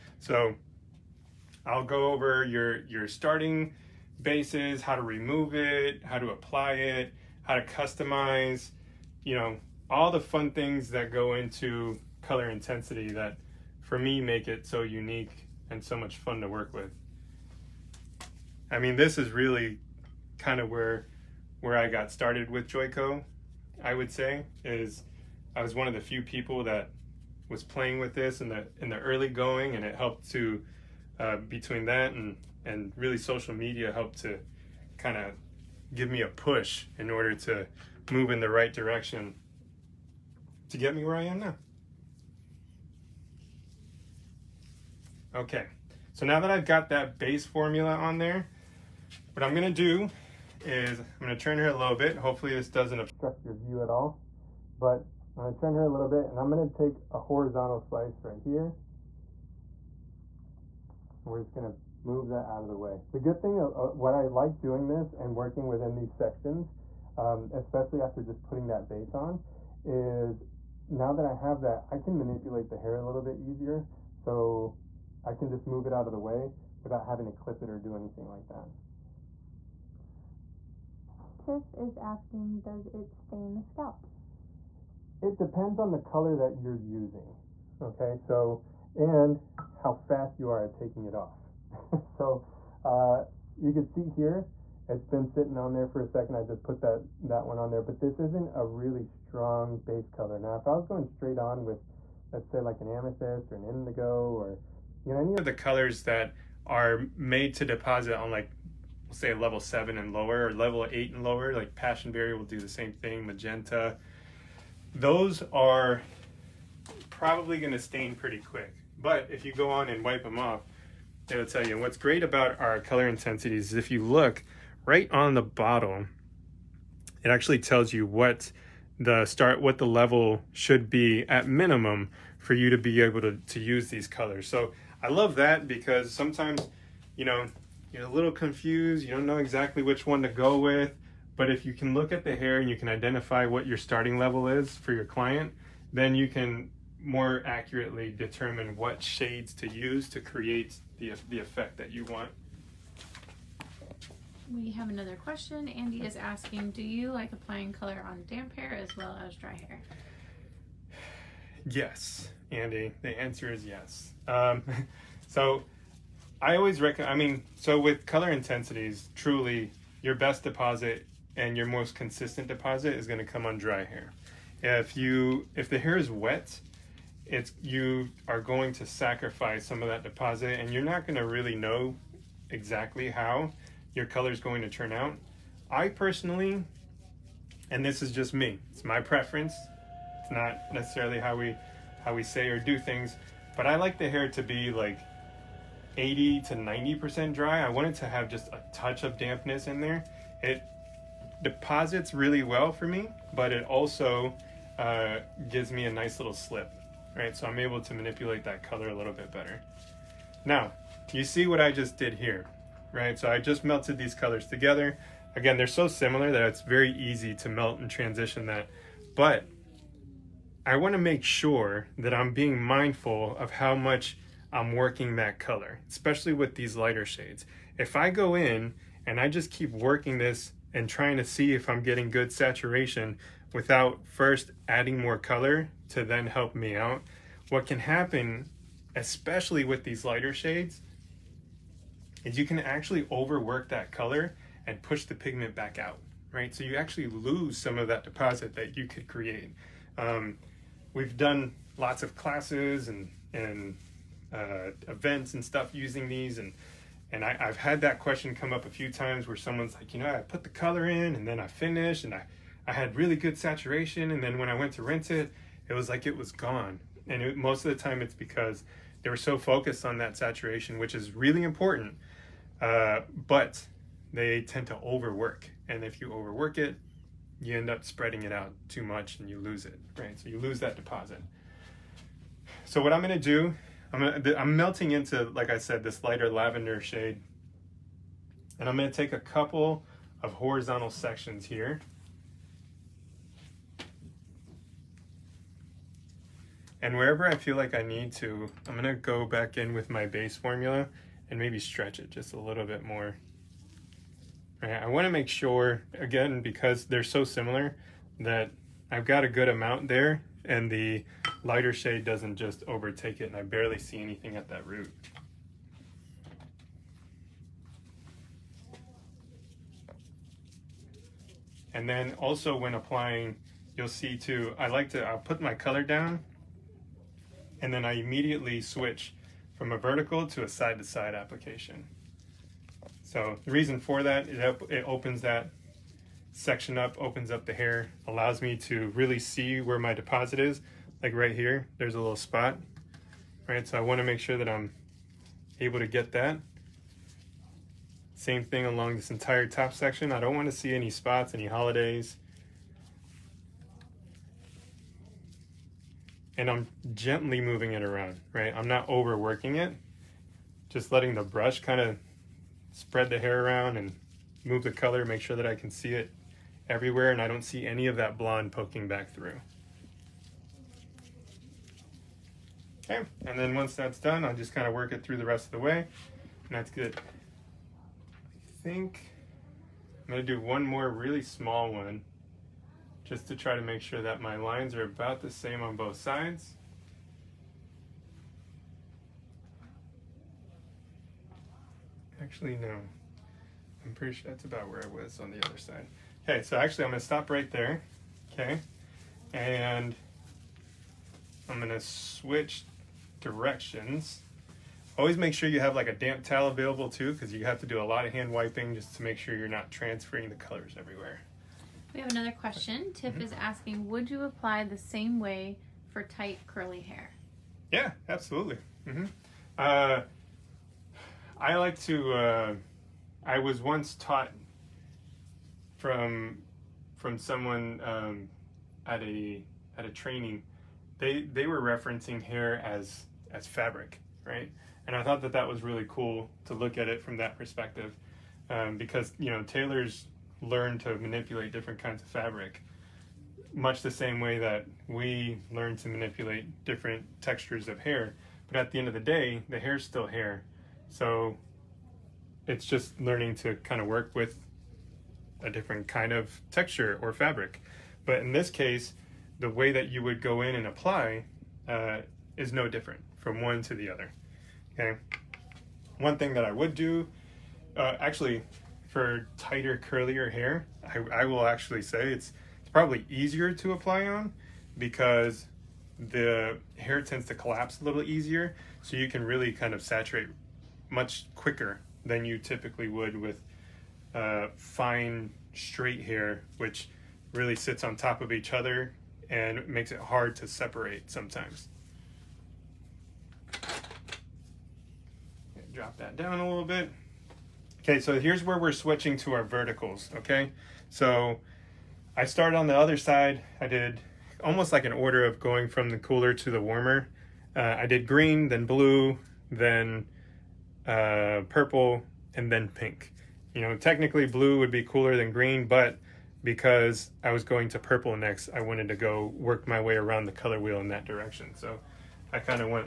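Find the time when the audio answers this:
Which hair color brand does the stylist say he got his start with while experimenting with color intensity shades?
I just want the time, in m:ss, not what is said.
0:22.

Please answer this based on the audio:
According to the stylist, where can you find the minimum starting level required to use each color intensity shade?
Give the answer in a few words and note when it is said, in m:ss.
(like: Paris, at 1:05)
on the bottle, at 2:04.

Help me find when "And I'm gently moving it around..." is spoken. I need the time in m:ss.
5:56.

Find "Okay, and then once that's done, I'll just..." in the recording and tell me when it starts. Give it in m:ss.
6:12.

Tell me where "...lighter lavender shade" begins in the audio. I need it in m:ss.
4:46.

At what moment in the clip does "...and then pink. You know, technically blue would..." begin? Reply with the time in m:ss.
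8:32.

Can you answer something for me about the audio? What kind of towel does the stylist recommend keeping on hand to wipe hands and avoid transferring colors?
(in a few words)
damp towel.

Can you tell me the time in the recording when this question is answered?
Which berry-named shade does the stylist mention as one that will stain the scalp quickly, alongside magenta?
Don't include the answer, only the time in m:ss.
1:51.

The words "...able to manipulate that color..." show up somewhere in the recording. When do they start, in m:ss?
3:27.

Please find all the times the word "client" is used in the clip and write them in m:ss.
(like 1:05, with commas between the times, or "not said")
2:25.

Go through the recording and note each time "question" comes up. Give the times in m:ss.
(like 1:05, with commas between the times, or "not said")
2:35, 4:17, 6:52.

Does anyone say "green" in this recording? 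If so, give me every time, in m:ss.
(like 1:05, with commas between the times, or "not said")
8:28, 8:35.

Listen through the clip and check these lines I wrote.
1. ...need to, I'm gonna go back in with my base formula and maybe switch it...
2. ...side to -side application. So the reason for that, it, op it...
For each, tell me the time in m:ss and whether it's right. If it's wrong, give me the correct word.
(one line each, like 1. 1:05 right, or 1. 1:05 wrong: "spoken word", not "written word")
1. 4:57 wrong: "stretch", not "switch"
2. 5:30 right.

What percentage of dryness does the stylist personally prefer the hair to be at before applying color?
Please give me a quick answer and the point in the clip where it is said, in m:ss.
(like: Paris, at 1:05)
80 to 90%, at 3:15.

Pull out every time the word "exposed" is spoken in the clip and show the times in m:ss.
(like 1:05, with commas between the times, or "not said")
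not said.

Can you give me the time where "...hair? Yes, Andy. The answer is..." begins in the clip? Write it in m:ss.
2:39.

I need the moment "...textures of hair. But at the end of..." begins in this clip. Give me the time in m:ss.
7:27.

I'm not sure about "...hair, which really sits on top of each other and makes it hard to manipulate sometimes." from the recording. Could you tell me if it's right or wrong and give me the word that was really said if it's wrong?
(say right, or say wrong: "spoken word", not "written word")
wrong: "separate", not "manipulate".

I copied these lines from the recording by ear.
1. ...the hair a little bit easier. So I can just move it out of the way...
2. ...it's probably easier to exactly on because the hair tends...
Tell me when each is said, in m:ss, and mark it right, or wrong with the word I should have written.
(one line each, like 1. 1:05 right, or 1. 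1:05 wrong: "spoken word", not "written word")
1. 1:12 right
2. 7:52 wrong: "apply", not "exactly".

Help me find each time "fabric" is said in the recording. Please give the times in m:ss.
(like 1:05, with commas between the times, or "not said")
7:13, 7:22, 7:37.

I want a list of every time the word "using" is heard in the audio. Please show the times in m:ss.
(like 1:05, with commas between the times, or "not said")
1:26, 4:15.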